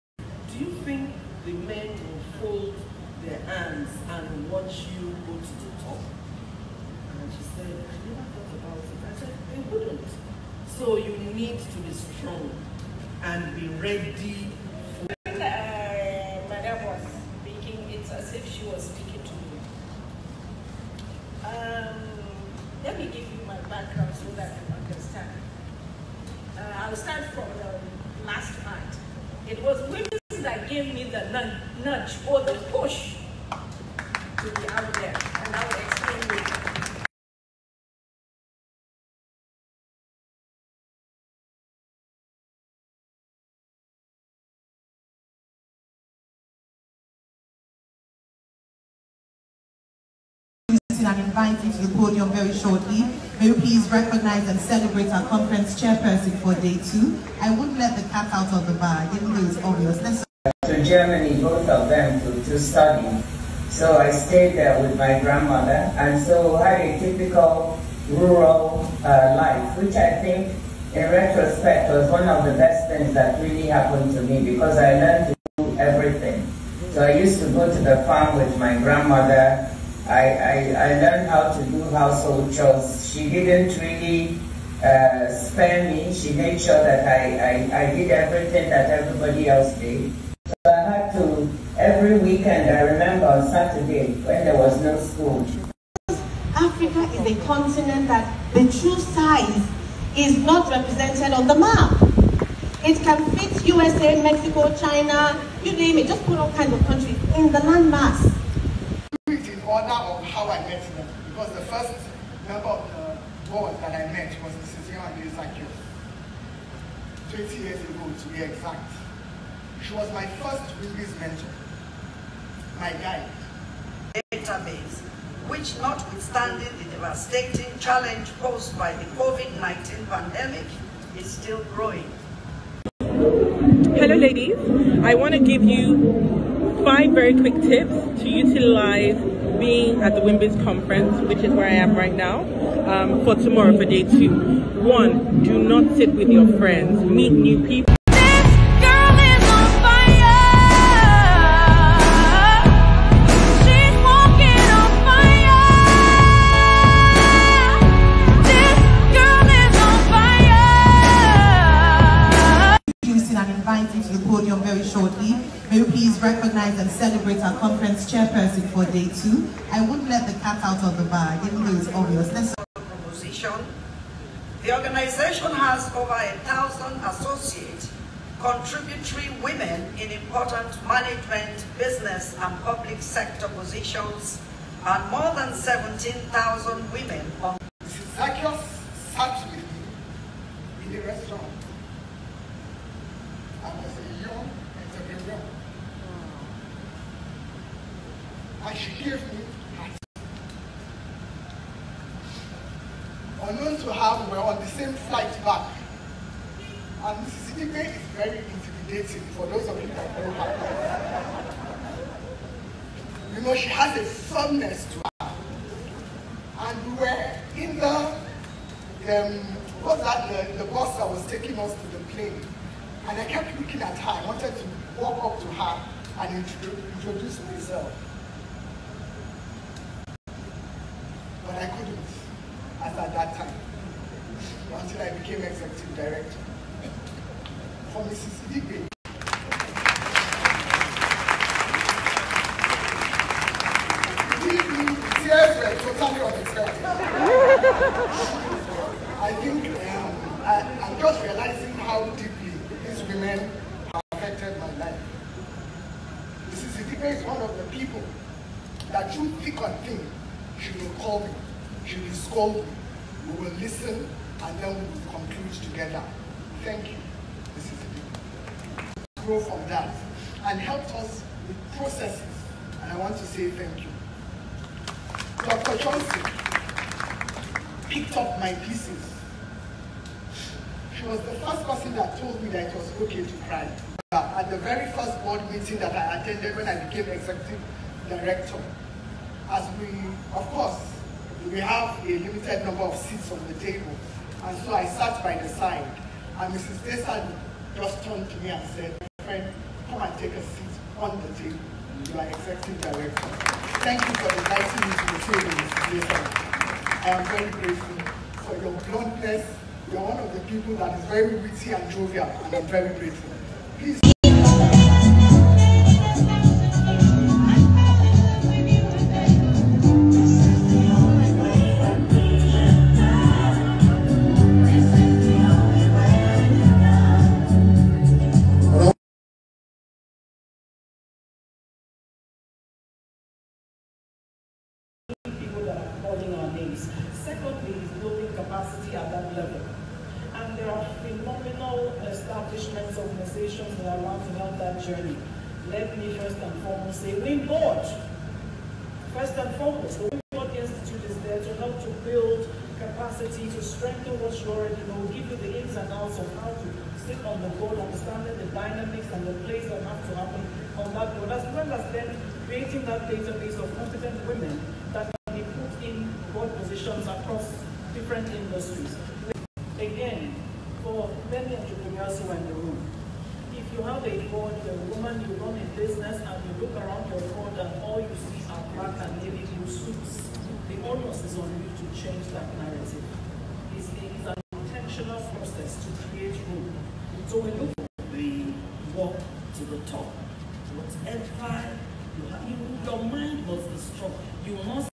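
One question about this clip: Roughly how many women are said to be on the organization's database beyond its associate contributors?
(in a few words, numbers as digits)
17,000.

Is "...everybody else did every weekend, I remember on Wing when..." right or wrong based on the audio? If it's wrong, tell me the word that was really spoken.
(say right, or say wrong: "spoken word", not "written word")
wrong: "Saturday", not "Wing".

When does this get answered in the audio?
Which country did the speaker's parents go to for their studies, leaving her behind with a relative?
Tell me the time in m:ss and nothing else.
1:00.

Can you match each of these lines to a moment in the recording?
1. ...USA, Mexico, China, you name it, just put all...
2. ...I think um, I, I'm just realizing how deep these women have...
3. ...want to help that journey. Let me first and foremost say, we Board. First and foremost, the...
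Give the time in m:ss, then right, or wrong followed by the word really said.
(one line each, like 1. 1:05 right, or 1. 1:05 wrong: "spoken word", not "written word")
1. 1:43 right
2. 4:09 right
3. 5:44 right.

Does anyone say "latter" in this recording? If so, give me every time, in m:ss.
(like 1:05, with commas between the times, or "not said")
not said.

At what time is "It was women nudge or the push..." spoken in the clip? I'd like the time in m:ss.
0:29.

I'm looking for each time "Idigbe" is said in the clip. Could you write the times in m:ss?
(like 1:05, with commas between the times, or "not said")
3:27, 3:58.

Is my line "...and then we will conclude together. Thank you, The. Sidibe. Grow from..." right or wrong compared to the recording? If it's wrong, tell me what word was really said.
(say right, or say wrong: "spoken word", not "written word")
wrong: "Mrs", not "The".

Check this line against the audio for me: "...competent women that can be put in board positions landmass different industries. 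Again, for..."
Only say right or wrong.
wrong.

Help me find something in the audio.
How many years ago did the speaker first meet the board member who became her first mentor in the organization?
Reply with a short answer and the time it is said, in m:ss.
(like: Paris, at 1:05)
20 years, at 1:57.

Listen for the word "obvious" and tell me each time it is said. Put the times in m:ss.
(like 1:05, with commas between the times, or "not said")
0:59, 2:51.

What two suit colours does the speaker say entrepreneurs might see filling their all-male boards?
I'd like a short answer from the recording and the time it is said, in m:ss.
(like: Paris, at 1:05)
Black and navy blue, at 6:18.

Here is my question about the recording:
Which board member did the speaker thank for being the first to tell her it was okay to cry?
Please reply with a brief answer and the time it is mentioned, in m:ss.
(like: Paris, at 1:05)
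Dr. Johnson, at 4:35.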